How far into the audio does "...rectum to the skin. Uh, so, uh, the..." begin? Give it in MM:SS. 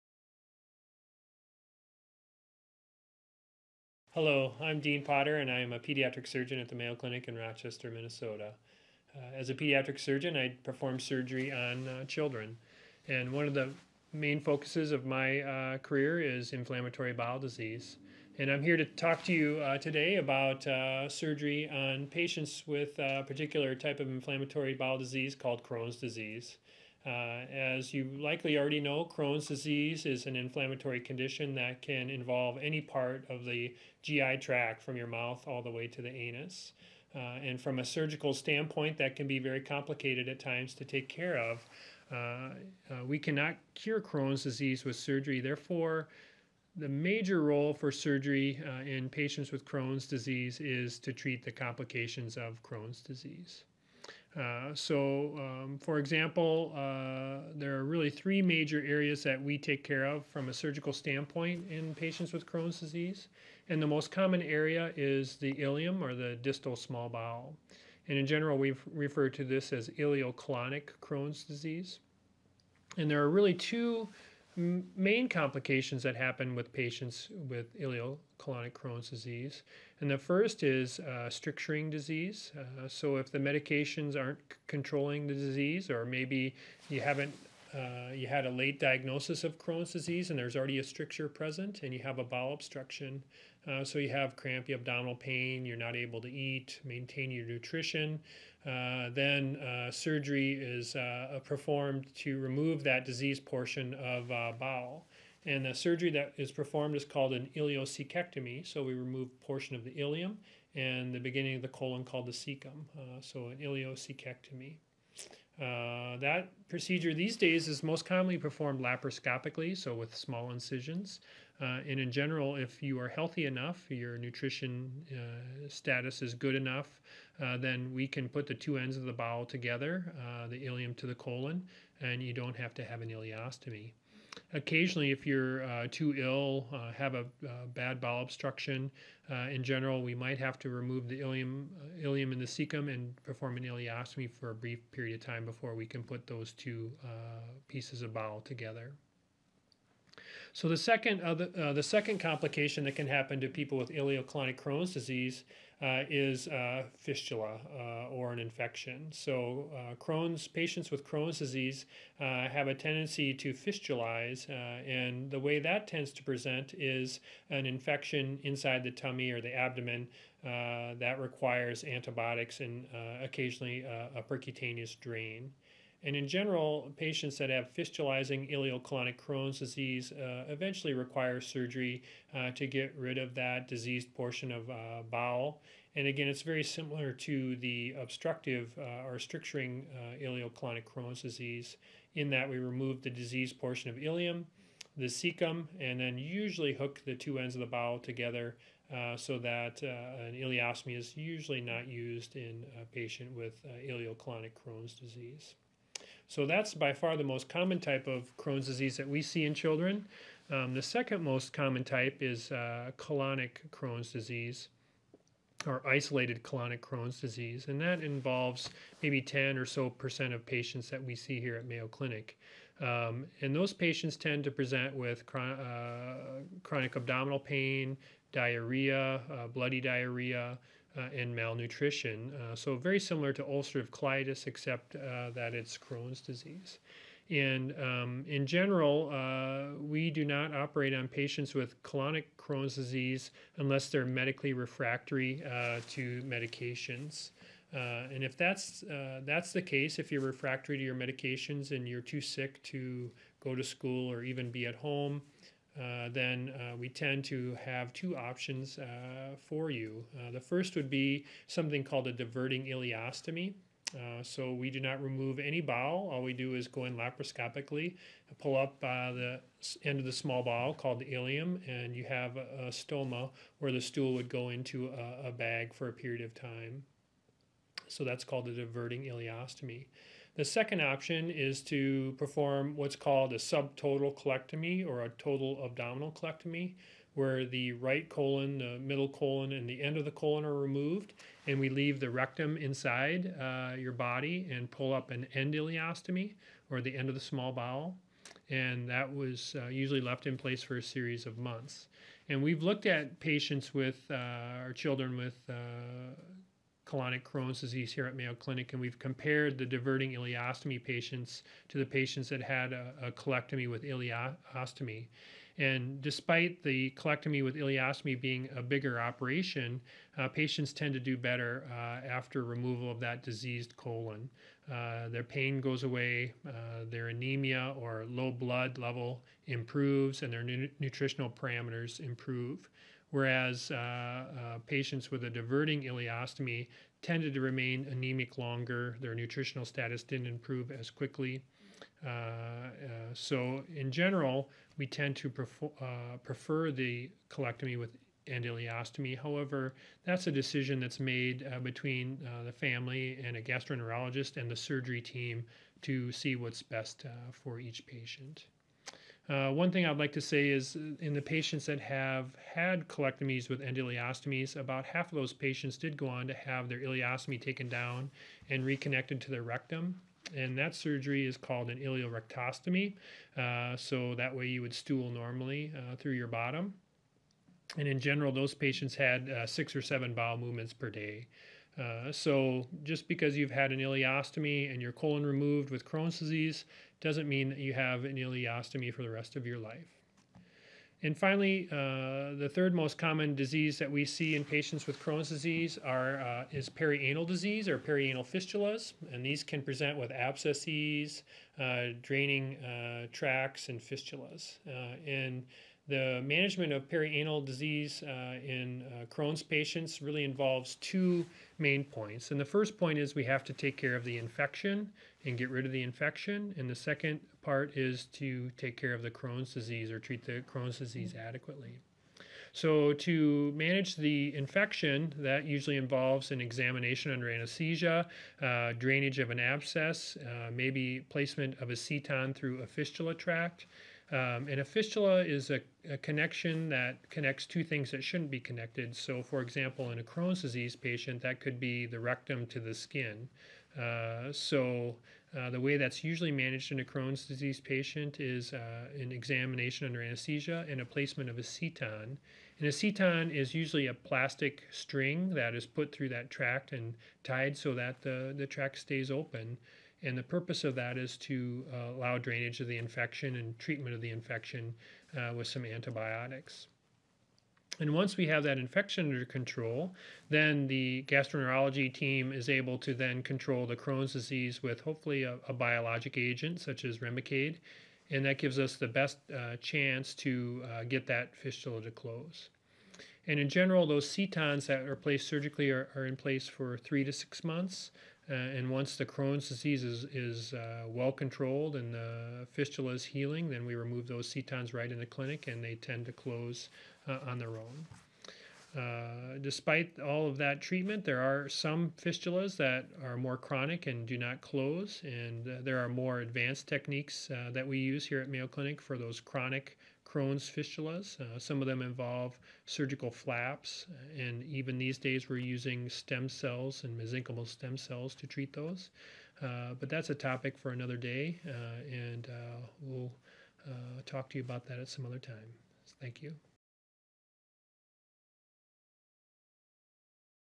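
07:21.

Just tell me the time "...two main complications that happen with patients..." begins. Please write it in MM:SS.
01:13.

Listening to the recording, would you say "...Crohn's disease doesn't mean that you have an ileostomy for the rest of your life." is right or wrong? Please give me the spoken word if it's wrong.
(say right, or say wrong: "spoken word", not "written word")
right.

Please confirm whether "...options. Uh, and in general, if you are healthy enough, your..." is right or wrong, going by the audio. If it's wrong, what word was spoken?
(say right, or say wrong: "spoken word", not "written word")
wrong: "incisions", not "options".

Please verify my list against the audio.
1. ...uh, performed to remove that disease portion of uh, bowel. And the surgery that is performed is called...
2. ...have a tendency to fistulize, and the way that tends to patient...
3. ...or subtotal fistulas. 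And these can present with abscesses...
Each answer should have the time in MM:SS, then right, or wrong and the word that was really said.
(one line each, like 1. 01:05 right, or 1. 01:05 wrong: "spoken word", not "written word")
1. 01:41 right
2. 02:42 wrong: "present", not "patient"
3. 06:37 wrong: "perianal", not "subtotal".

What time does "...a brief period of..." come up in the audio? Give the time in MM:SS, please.
02:24.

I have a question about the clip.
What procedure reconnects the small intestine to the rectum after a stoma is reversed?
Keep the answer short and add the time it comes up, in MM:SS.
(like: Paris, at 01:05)
ileorectostomy, at 06:11.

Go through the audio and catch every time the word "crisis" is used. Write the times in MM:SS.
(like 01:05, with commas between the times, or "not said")
not said.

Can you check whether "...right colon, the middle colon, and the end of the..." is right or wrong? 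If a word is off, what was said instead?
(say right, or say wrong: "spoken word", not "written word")
right.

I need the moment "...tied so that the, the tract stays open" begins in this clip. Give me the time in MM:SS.
07:37.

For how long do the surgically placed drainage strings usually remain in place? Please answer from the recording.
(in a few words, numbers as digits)
3 to 6 months.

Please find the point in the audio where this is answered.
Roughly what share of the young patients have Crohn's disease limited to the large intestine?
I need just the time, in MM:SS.
03:39.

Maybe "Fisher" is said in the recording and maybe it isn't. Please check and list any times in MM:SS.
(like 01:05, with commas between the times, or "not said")
not said.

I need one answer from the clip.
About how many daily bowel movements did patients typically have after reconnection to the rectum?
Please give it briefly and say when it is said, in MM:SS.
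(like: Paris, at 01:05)
6 or 7, at 06:19.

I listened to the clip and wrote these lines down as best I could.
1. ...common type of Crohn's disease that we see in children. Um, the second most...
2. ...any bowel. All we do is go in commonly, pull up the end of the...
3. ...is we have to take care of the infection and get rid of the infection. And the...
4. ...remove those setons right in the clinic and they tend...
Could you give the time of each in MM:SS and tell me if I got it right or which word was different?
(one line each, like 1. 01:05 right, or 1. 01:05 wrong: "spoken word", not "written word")
1. 03:27 right
2. 04:25 wrong: "laparoscopically", not "commonly"
3. 06:52 right
4. 08:13 right.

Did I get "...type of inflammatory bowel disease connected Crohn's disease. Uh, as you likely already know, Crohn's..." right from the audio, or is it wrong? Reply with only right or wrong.
wrong.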